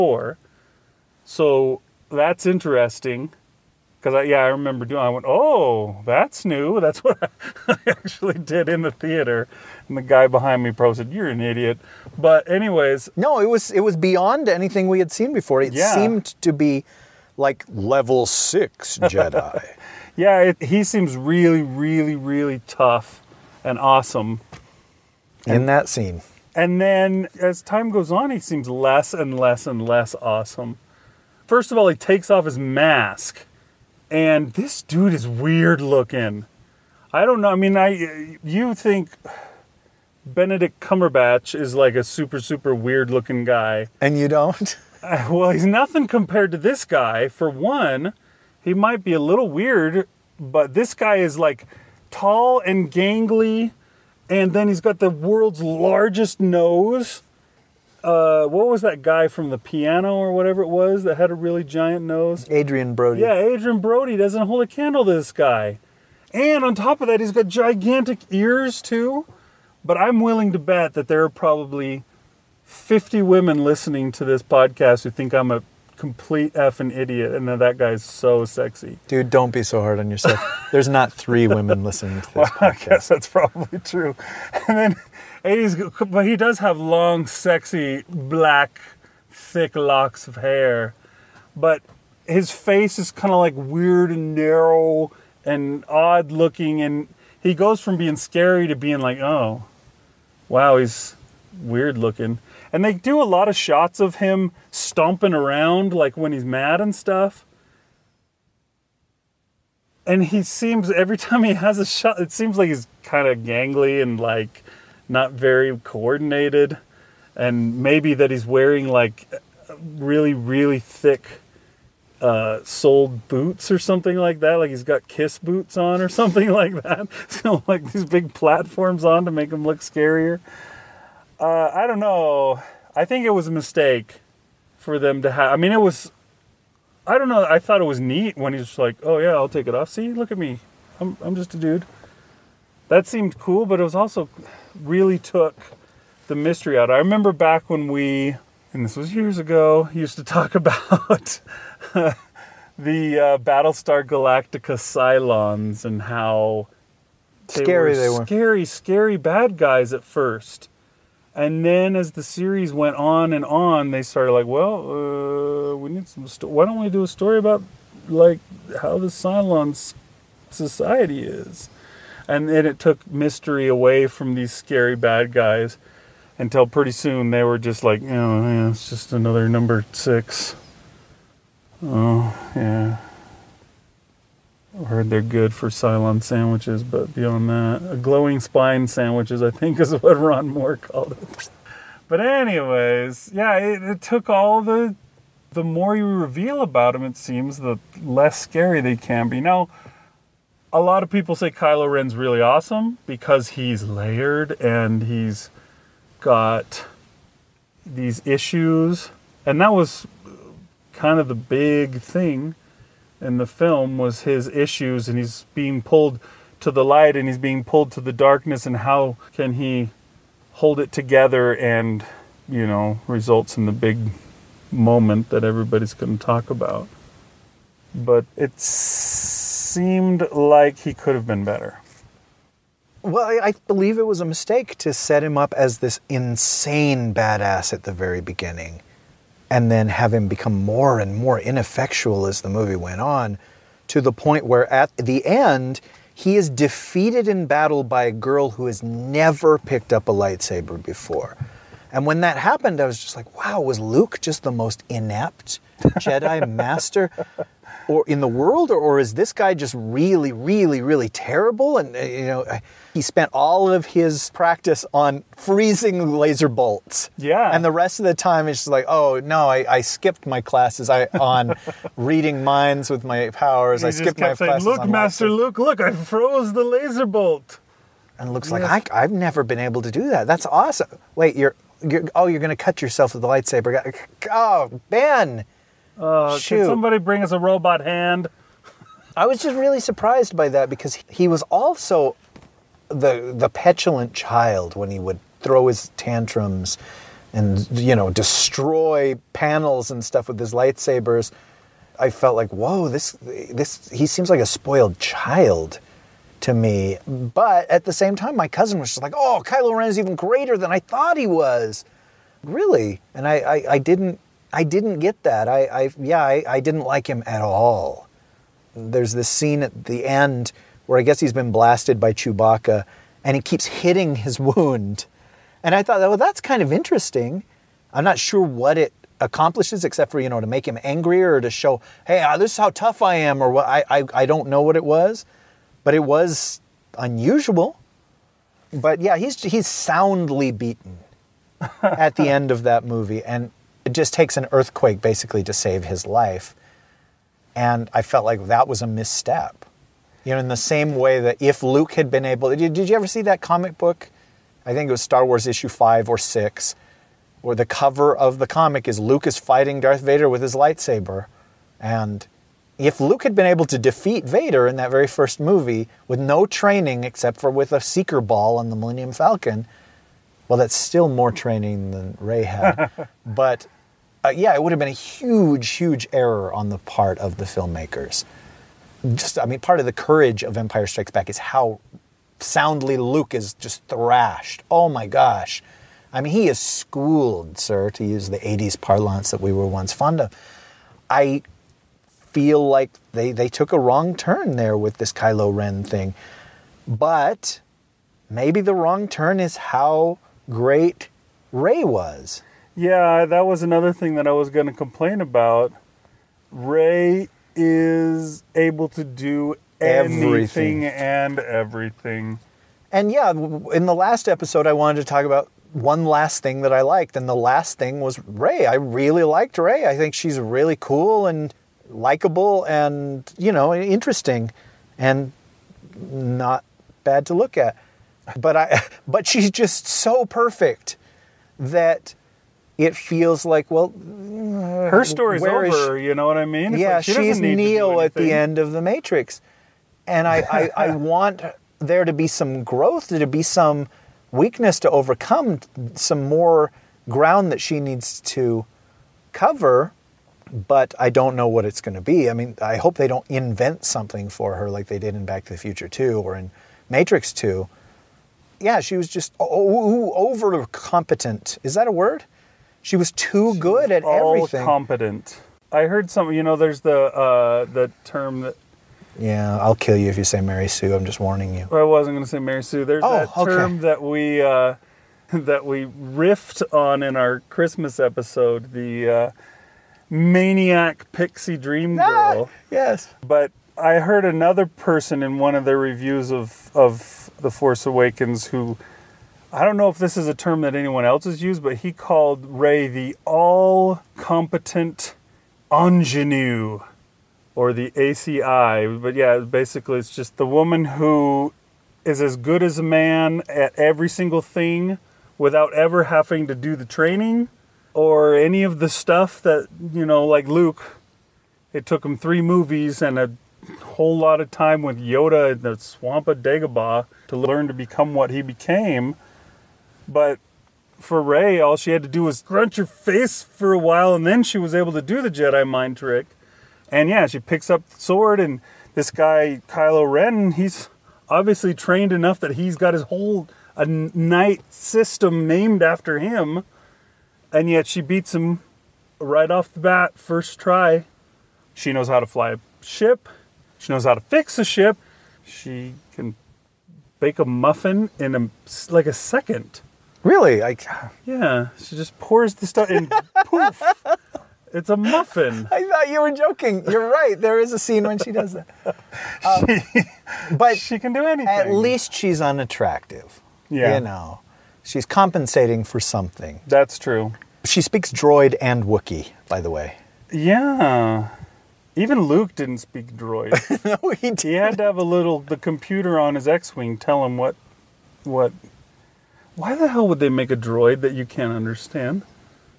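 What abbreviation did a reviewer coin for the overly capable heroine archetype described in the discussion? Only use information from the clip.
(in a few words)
ACI.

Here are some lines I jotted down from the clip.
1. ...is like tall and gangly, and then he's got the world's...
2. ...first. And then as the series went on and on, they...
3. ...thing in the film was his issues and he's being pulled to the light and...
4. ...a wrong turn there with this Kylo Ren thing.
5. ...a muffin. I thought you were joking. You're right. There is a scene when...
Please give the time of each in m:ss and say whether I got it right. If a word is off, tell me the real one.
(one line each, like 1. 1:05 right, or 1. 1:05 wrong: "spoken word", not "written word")
1. 0:51 right
2. 2:40 right
3. 3:32 right
4. 6:33 right
5. 9:14 right.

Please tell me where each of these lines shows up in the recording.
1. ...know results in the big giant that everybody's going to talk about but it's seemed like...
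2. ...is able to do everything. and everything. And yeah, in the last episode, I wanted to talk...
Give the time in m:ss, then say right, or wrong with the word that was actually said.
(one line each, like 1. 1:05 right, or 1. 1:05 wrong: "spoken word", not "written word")
1. 3:42 wrong: "moment", not "giant"
2. 6:47 right.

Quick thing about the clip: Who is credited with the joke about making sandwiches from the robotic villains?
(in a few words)
Ron Moore.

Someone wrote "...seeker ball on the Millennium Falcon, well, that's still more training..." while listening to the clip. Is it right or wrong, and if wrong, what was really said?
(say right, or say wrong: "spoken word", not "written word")
right.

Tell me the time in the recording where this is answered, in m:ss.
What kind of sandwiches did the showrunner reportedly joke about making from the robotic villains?
3:07.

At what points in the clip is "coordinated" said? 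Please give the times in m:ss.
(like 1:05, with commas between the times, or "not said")
1:55.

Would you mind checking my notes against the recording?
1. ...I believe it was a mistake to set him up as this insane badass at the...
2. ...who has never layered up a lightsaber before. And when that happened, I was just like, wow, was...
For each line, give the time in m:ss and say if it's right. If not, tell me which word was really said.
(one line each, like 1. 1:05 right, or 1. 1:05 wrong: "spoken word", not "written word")
1. 3:53 right
2. 4:08 wrong: "picked", not "layered".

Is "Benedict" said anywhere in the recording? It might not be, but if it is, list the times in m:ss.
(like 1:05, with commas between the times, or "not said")
0:40.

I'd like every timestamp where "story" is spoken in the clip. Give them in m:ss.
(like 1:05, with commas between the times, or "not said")
2:47, 7:15.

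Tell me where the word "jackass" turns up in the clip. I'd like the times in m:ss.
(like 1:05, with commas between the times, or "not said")
not said.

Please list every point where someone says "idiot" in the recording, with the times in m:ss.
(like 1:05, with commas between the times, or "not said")
0:11, 1:16.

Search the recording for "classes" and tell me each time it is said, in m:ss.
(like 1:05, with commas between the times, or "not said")
4:30, 4:34.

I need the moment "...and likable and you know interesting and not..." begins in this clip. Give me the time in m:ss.
7:01.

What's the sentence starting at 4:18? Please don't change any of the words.
Or, or, is this guy just really, really, really terrible?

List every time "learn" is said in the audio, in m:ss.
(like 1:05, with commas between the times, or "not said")
8:37.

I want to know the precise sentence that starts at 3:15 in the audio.
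The more you reveal about them, it seems, the less scary they can be.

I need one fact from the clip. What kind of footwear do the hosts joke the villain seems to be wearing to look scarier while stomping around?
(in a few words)
Kiss boots.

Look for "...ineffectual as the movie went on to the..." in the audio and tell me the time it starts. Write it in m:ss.
4:01.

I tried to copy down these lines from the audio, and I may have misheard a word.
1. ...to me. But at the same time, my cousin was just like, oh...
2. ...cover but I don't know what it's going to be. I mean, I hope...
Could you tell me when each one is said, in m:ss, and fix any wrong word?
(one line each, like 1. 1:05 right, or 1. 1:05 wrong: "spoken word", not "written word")
1. 5:06 right
2. 7:29 right.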